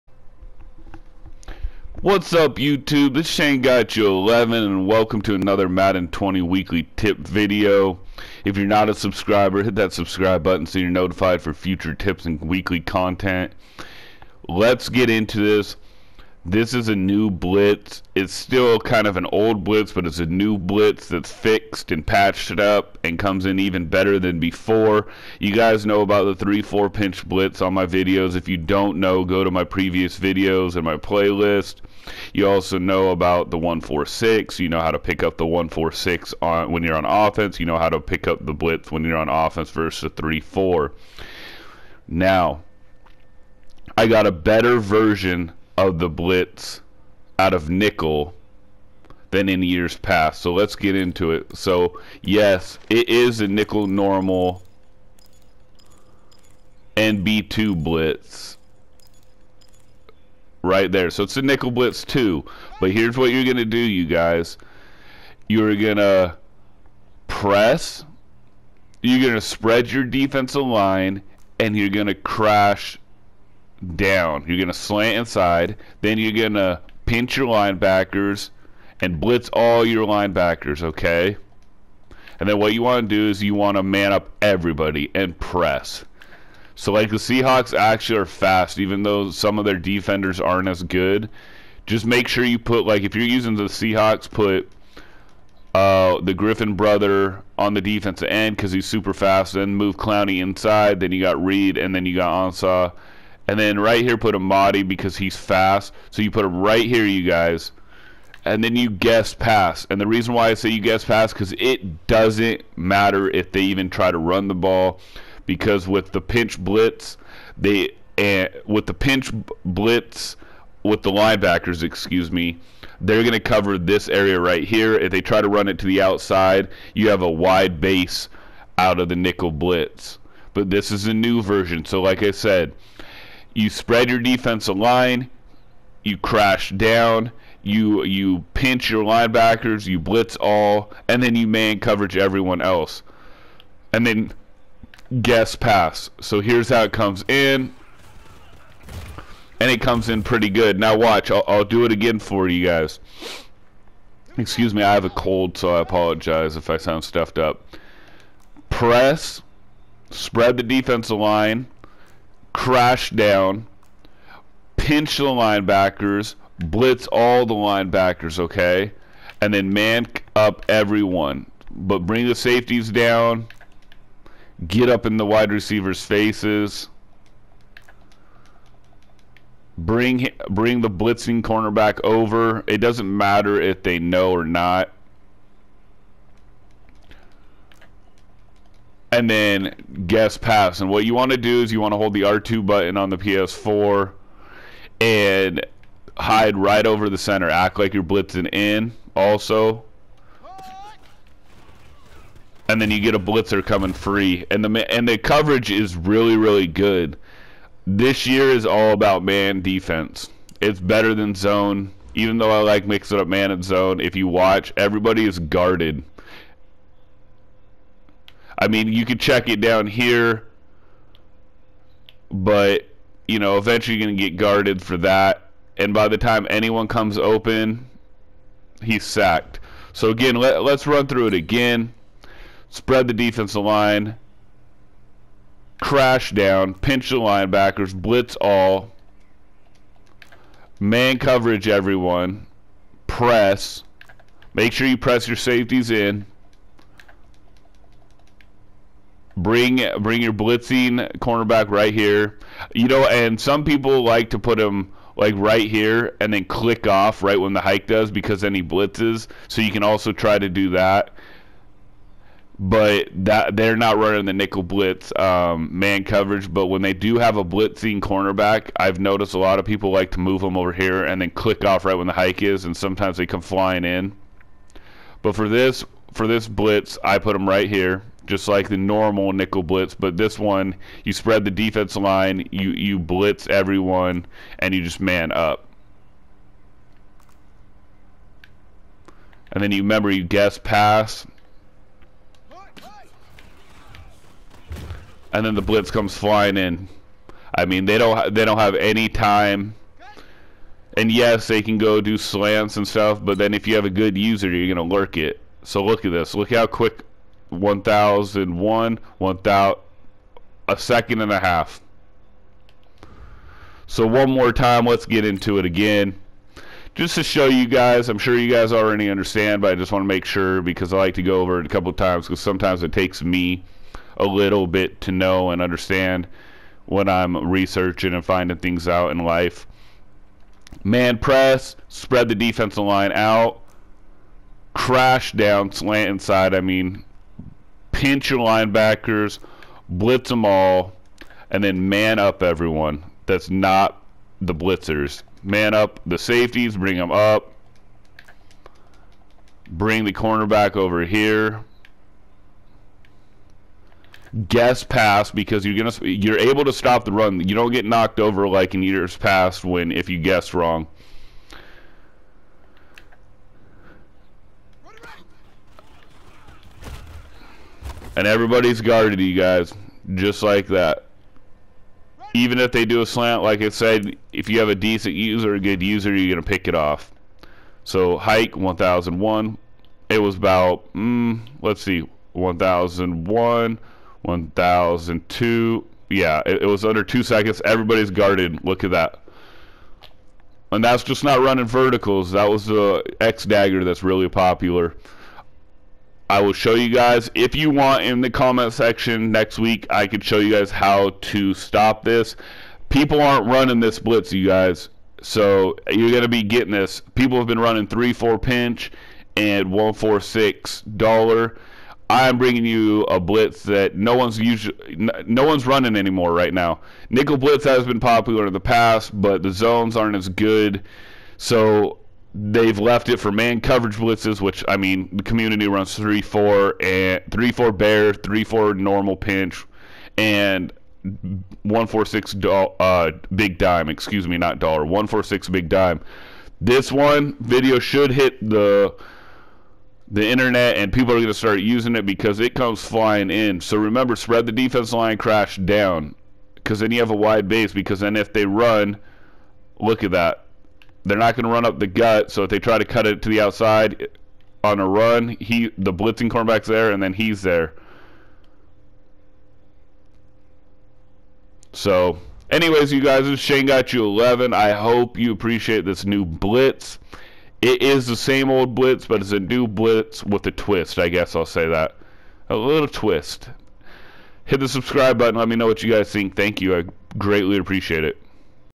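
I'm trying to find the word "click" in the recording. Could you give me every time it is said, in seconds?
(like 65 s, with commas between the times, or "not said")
256 s, 271 s.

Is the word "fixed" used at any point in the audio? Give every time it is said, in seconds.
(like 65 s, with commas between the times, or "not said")
21 s.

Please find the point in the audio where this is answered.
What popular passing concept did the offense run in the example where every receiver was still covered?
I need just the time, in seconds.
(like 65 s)
393 s.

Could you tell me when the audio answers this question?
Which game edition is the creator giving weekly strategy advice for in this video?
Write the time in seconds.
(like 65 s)
5 s.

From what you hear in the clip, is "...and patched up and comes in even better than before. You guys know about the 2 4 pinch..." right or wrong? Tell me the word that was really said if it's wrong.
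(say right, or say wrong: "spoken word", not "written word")
wrong: "3", not "2".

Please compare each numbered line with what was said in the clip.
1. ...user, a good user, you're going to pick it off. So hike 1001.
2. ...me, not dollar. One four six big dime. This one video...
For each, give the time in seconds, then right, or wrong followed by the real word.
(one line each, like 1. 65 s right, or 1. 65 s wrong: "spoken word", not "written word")
1. 375 s right
2. 434 s right.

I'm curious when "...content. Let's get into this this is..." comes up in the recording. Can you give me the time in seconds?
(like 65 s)
12 s.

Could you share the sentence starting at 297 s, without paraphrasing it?
I mean, they don't they don't have any time.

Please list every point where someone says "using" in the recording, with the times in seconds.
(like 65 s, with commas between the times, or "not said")
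93 s, 441 s.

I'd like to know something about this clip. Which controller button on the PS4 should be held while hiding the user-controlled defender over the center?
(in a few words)
R2.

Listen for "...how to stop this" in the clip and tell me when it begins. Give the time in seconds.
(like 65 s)
400 s.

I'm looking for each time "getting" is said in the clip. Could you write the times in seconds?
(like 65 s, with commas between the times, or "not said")
406 s.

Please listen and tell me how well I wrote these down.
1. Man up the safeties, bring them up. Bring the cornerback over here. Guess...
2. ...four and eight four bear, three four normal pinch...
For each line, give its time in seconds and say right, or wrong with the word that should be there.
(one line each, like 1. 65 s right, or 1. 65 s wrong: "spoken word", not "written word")
1. 345 s right
2. 426 s wrong: "three", not "eight".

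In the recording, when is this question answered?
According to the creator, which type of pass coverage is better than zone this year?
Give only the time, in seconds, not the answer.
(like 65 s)
209 s.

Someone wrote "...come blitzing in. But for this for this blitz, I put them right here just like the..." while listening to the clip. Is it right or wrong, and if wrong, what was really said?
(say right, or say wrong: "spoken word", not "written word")
wrong: "flying", not "blitzing".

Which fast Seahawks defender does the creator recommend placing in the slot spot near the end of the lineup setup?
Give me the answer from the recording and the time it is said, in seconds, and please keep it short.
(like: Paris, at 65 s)
Amadi, at 104 s.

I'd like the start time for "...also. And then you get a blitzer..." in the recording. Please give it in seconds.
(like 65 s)
199 s.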